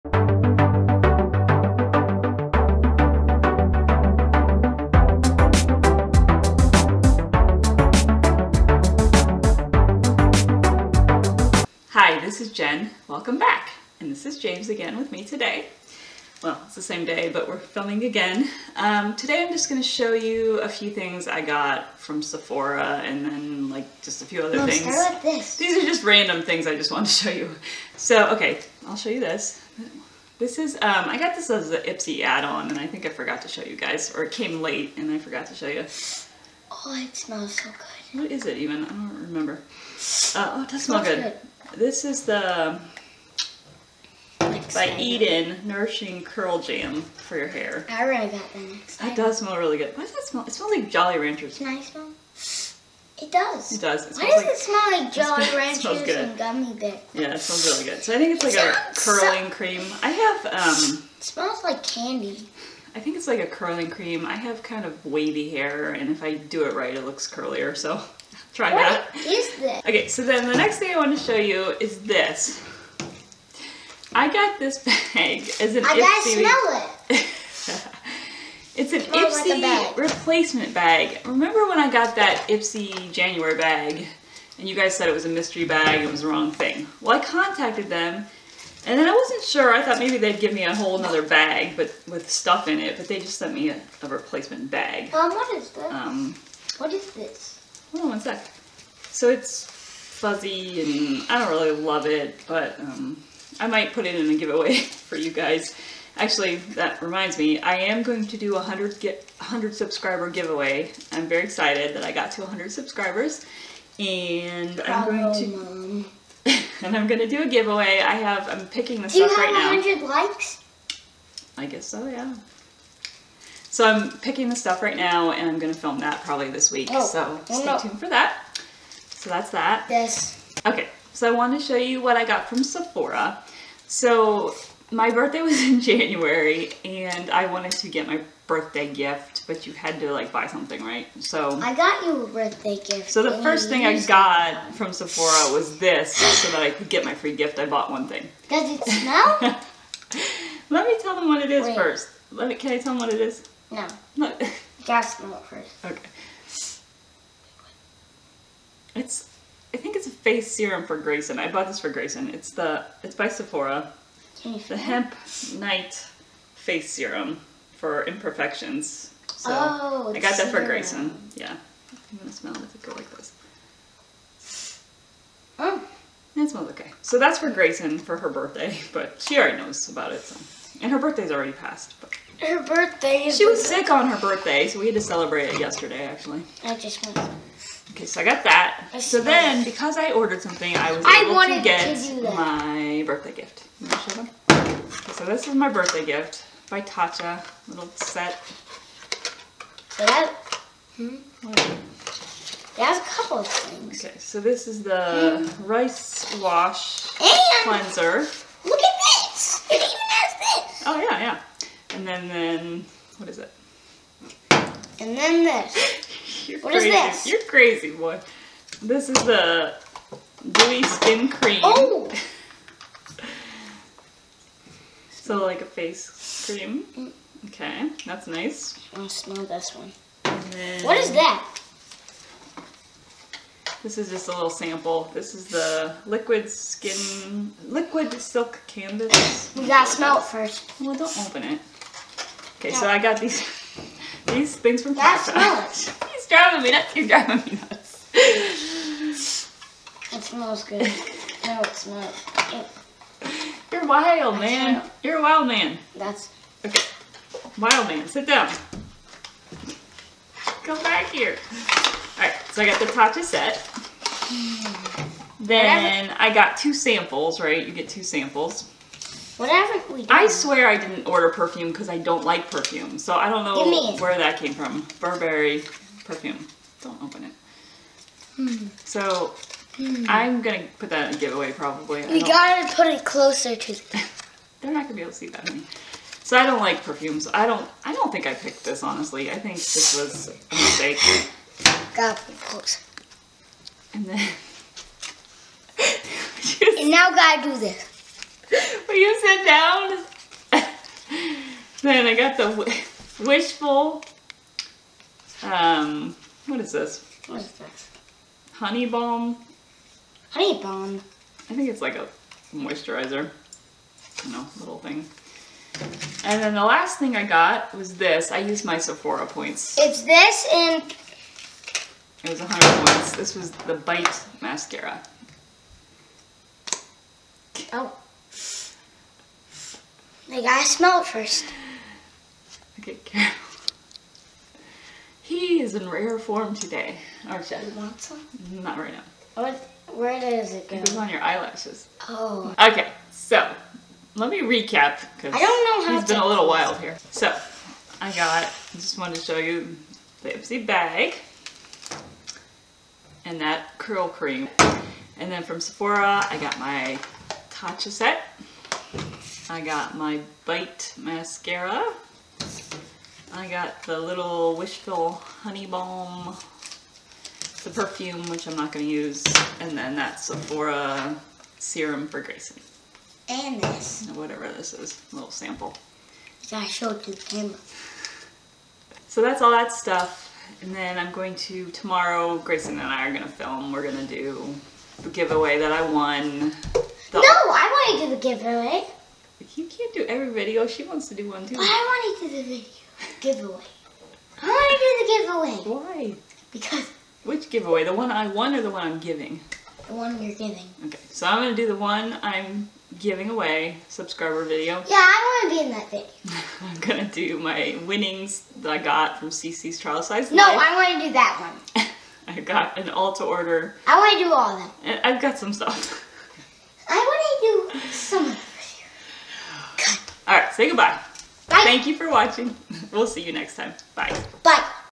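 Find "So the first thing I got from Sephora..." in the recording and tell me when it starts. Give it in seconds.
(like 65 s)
143 s.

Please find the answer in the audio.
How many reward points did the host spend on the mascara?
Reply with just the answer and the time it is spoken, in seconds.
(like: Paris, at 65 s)
100, at 322 s.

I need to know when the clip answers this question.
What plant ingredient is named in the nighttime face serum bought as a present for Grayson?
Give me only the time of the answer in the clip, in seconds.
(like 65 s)
164 s.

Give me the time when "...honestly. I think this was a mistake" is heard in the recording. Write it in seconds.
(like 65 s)
288 s.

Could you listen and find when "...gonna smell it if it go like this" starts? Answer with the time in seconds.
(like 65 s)
172 s.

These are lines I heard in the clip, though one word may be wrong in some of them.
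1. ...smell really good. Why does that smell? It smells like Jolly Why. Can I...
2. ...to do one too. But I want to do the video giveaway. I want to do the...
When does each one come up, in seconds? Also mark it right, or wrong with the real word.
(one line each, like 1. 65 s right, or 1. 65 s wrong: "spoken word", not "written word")
1. 49 s wrong: "Ranchers", not "Why"
2. 391 s right.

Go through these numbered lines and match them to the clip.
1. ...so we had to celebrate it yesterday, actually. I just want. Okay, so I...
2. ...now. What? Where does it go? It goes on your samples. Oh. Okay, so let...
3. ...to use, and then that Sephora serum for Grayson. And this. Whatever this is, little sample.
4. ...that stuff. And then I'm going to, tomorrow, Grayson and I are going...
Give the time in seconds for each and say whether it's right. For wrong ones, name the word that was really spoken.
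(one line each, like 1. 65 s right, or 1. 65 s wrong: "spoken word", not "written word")
1. 184 s right
2. 338 s wrong: "eyelashes", not "samples"
3. 368 s right
4. 379 s right.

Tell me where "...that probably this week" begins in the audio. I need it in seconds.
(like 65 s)
125 s.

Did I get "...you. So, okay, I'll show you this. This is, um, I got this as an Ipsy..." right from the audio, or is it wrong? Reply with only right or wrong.
right.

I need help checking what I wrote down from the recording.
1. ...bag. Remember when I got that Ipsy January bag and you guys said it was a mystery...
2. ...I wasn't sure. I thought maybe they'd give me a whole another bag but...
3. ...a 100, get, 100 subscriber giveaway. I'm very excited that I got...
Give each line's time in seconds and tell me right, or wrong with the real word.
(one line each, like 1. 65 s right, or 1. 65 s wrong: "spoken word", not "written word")
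1. 80 s right
2. 89 s right
3. 108 s right.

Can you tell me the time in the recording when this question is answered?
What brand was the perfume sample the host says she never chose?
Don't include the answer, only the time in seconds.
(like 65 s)
274 s.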